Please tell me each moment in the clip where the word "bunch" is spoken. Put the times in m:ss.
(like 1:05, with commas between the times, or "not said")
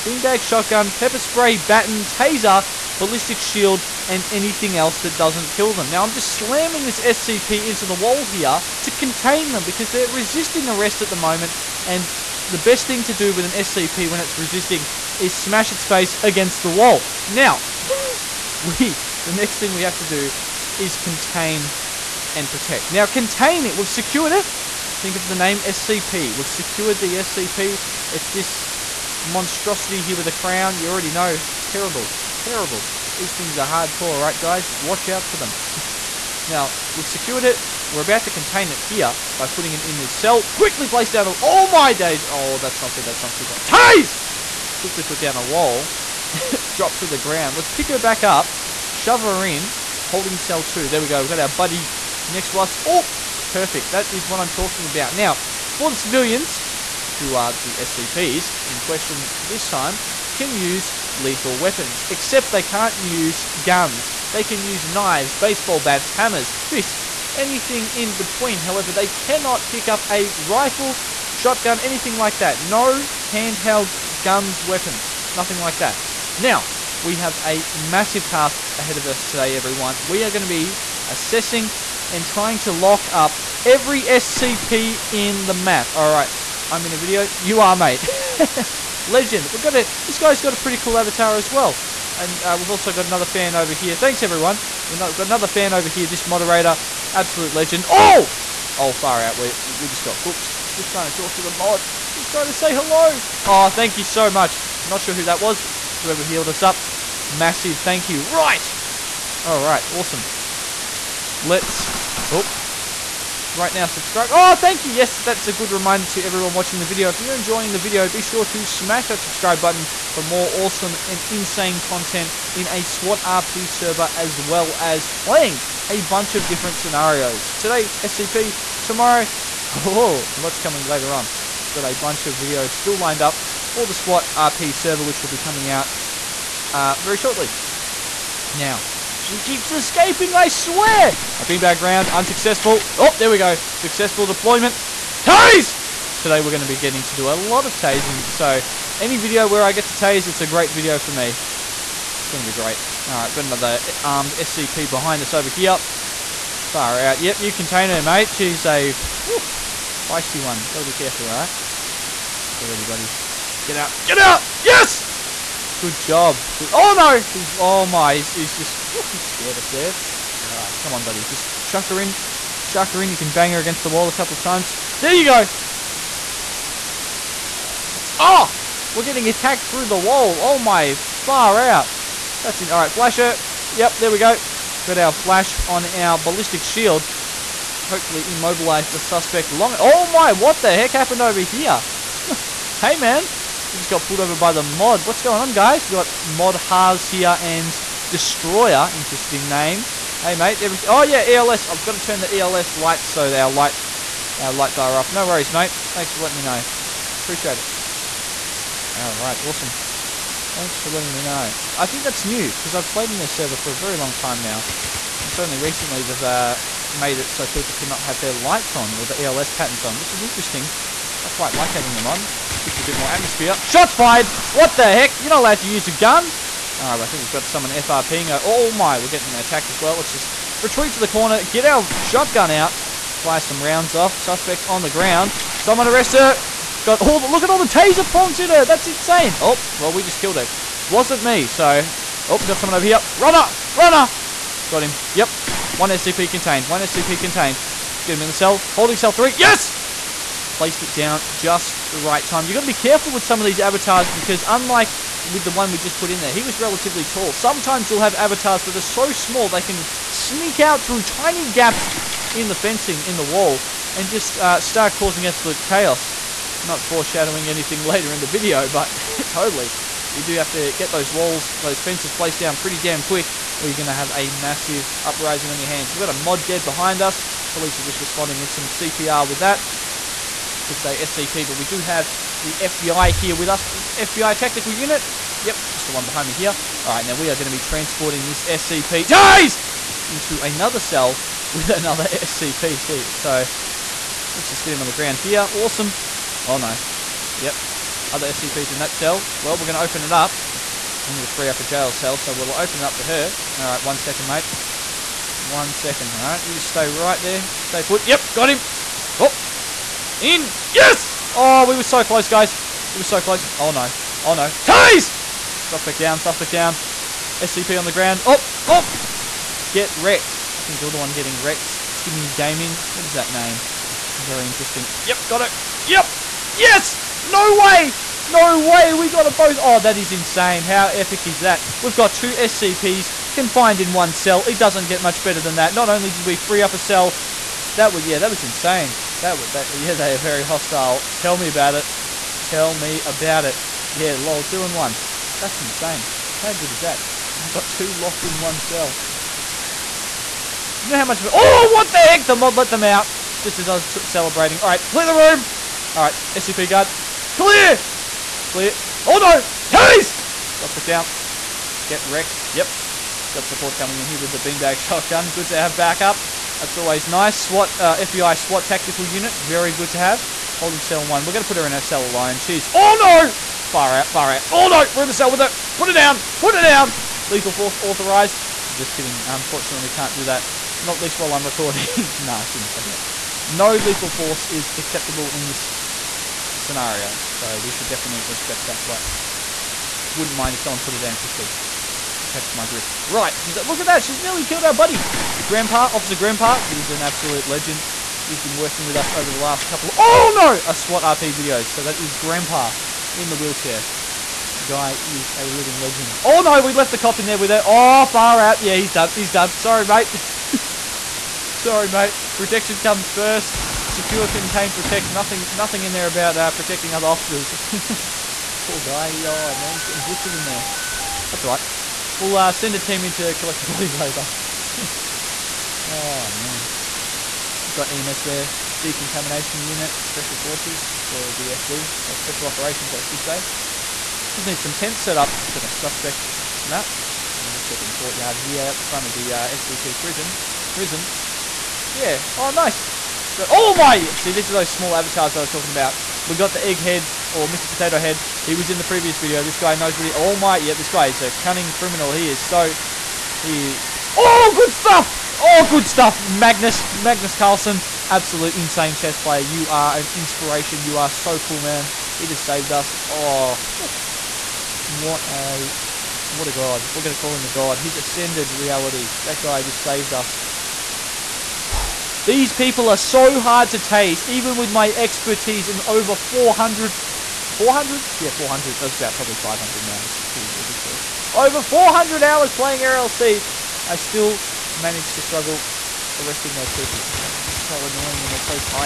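2:06, 2:11.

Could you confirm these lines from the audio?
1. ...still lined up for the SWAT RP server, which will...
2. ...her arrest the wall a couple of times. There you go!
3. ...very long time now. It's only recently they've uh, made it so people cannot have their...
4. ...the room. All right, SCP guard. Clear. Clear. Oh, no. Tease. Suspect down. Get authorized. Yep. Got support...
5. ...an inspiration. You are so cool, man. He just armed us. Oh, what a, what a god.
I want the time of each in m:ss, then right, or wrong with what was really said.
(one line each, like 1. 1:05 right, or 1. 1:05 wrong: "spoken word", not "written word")
1. 2:12 right
2. 2:53 wrong: "against", not "arrest"
3. 3:33 right
4. 5:55 wrong: "wrecked", not "authorized"
5. 7:39 wrong: "saved", not "armed".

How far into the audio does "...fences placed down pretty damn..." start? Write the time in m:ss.
4:31.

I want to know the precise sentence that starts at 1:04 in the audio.
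They can use knives, baseball bats, hammers, fists, anything in between.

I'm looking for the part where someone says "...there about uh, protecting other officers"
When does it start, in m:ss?
6:55.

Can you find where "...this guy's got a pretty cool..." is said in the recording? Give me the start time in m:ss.
1:30.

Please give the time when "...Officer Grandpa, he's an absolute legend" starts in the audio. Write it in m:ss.
6:35.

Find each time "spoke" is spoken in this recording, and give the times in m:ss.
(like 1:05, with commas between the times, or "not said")
not said.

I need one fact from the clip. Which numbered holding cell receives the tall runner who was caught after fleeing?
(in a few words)
Holding cell three.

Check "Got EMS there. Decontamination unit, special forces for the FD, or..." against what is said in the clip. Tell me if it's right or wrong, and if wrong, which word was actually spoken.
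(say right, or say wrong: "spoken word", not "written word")
right.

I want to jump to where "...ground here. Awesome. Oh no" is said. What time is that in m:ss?
4:54.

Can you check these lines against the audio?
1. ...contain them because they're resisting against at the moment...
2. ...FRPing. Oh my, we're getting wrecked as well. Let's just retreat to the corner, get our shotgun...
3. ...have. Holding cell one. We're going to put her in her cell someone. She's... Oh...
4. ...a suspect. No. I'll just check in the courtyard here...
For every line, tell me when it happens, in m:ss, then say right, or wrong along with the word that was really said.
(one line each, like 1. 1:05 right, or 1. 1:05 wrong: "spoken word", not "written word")
1. 0:08 wrong: "arrest", not "against"
2. 3:47 wrong: "attacked", not "wrecked"
3. 6:09 wrong: "alone", not "someone"
4. 7:15 right.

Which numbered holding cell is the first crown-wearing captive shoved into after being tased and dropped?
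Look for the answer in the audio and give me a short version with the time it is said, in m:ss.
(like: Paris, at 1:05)
Holding cell two, at 0:50.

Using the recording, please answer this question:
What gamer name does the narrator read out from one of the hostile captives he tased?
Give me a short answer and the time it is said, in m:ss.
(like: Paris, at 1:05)
Timmy Gaming, at 5:21.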